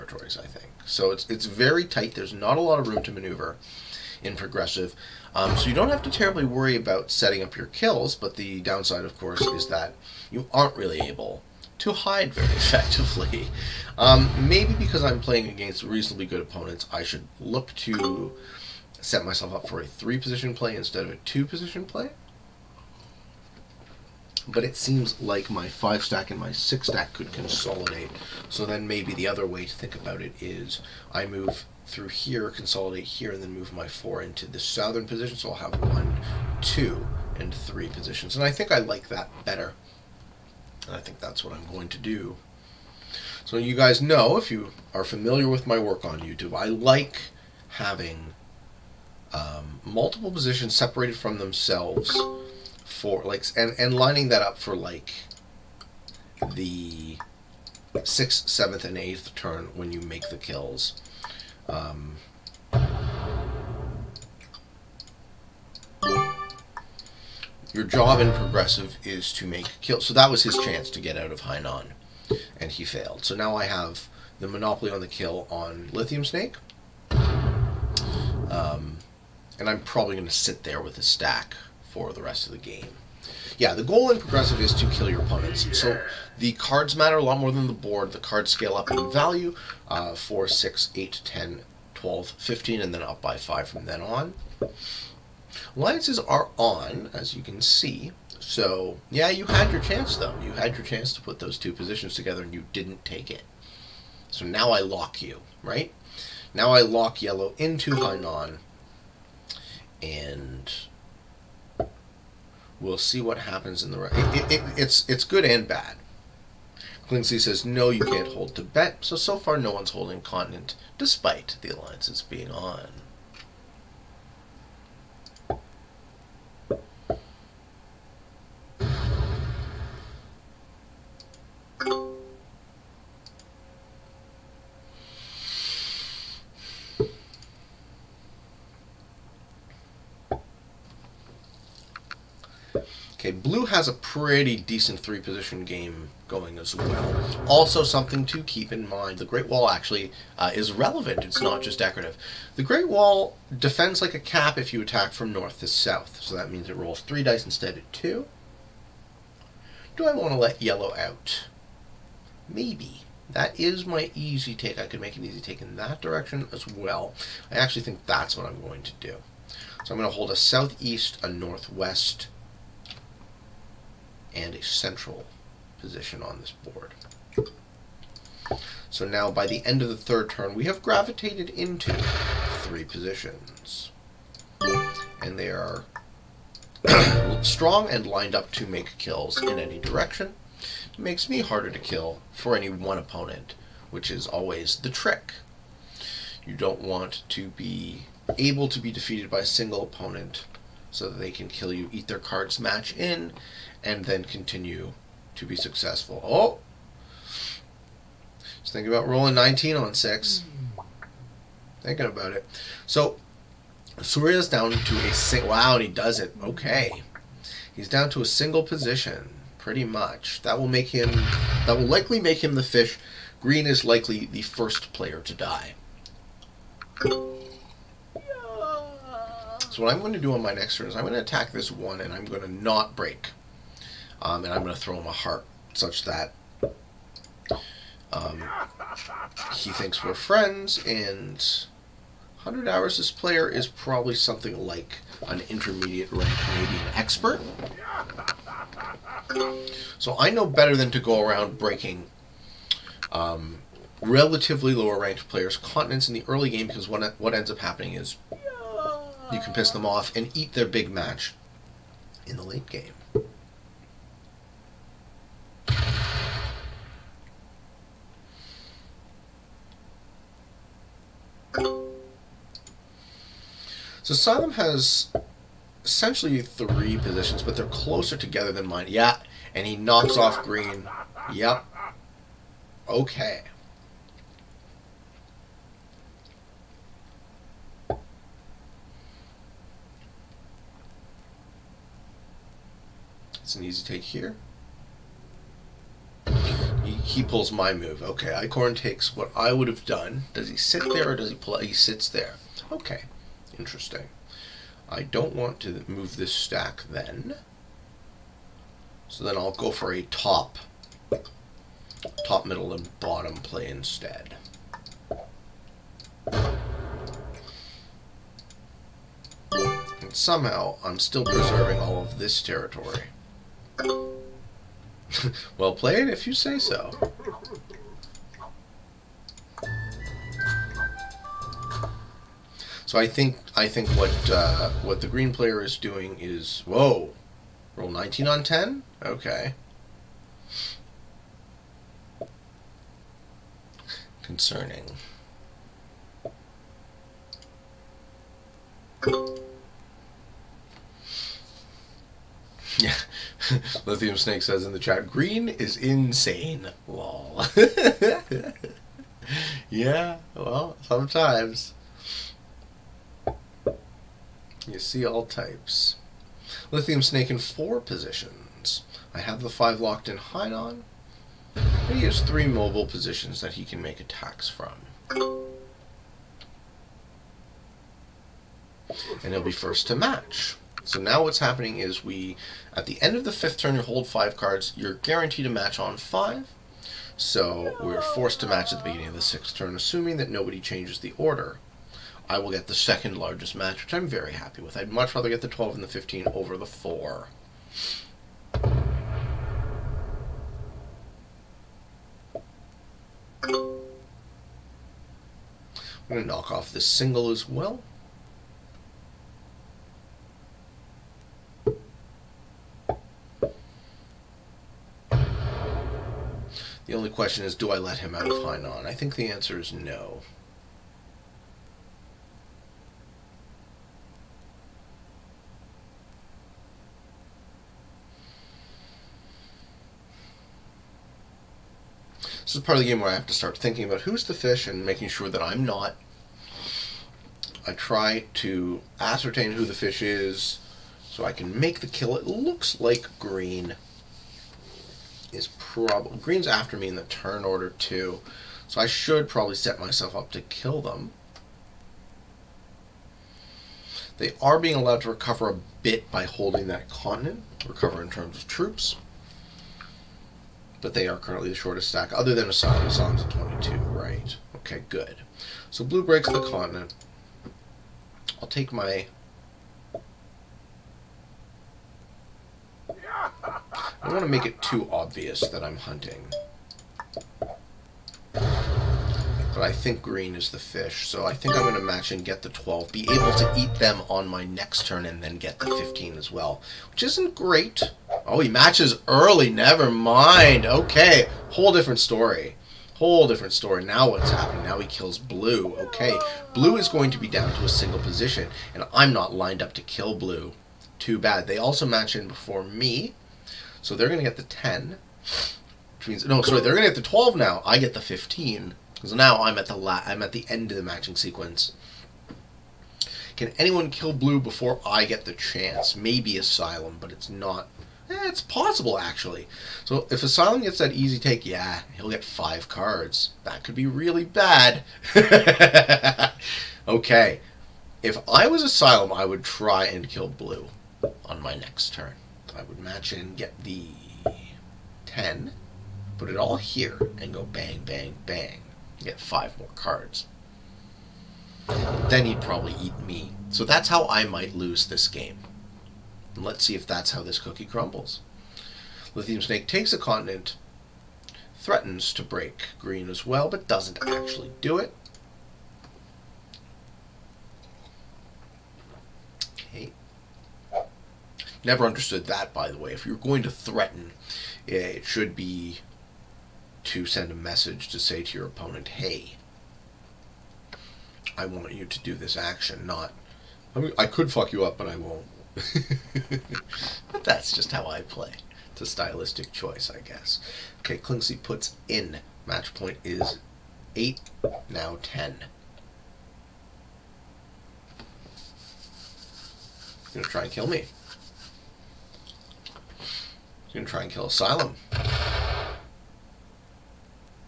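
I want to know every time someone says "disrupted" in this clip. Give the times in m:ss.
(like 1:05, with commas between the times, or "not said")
not said.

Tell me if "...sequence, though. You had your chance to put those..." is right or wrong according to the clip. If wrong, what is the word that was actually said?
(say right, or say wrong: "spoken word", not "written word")
wrong: "chance", not "sequence".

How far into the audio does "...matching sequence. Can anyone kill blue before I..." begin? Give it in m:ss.
8:30.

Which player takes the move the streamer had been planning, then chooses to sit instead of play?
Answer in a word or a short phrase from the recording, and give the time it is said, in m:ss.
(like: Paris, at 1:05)
Eichorn, at 4:58.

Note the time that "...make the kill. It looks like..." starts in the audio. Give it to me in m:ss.
7:21.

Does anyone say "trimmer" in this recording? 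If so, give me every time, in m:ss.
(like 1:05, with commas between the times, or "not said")
not said.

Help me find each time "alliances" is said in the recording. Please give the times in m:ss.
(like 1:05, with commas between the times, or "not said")
1:35, 2:01.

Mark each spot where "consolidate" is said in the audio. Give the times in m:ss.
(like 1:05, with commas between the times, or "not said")
0:27, 0:32.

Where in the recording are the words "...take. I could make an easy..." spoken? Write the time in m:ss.
2:44.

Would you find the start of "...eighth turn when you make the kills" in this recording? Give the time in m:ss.
0:58.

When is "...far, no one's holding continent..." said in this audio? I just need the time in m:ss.
1:59.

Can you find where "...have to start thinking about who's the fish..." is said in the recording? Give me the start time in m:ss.
7:13.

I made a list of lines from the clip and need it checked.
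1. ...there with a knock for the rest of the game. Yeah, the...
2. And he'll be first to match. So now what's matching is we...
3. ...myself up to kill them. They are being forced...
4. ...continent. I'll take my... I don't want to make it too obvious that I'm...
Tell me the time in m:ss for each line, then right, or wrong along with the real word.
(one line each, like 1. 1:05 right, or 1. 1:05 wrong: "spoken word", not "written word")
1. 1:20 wrong: "stack", not "knock"
2. 6:19 wrong: "happening", not "matching"
3. 7:29 wrong: "allowed", not "forced"
4. 7:46 right.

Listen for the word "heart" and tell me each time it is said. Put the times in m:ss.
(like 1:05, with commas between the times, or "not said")
3:55.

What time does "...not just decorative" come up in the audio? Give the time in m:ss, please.
2:31.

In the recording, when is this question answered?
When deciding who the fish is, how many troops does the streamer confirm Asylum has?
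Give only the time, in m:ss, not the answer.
7:43.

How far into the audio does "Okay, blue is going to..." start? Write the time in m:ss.
8:15.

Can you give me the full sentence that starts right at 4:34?
So Asylum has essentially three positions, but they're closer together than mine.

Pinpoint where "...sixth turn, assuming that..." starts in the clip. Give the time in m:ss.
6:29.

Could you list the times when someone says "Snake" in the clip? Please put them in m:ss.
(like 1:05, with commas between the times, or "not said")
1:16, 5:54, 6:07, 9:09.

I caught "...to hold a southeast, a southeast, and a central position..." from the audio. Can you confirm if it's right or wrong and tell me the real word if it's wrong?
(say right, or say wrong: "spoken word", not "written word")
wrong: "northwest", not "southeast".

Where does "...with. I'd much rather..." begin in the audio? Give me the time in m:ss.
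6:34.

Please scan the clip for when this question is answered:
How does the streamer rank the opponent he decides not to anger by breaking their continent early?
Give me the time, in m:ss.
4:05.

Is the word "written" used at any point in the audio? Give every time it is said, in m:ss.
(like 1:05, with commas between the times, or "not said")
not said.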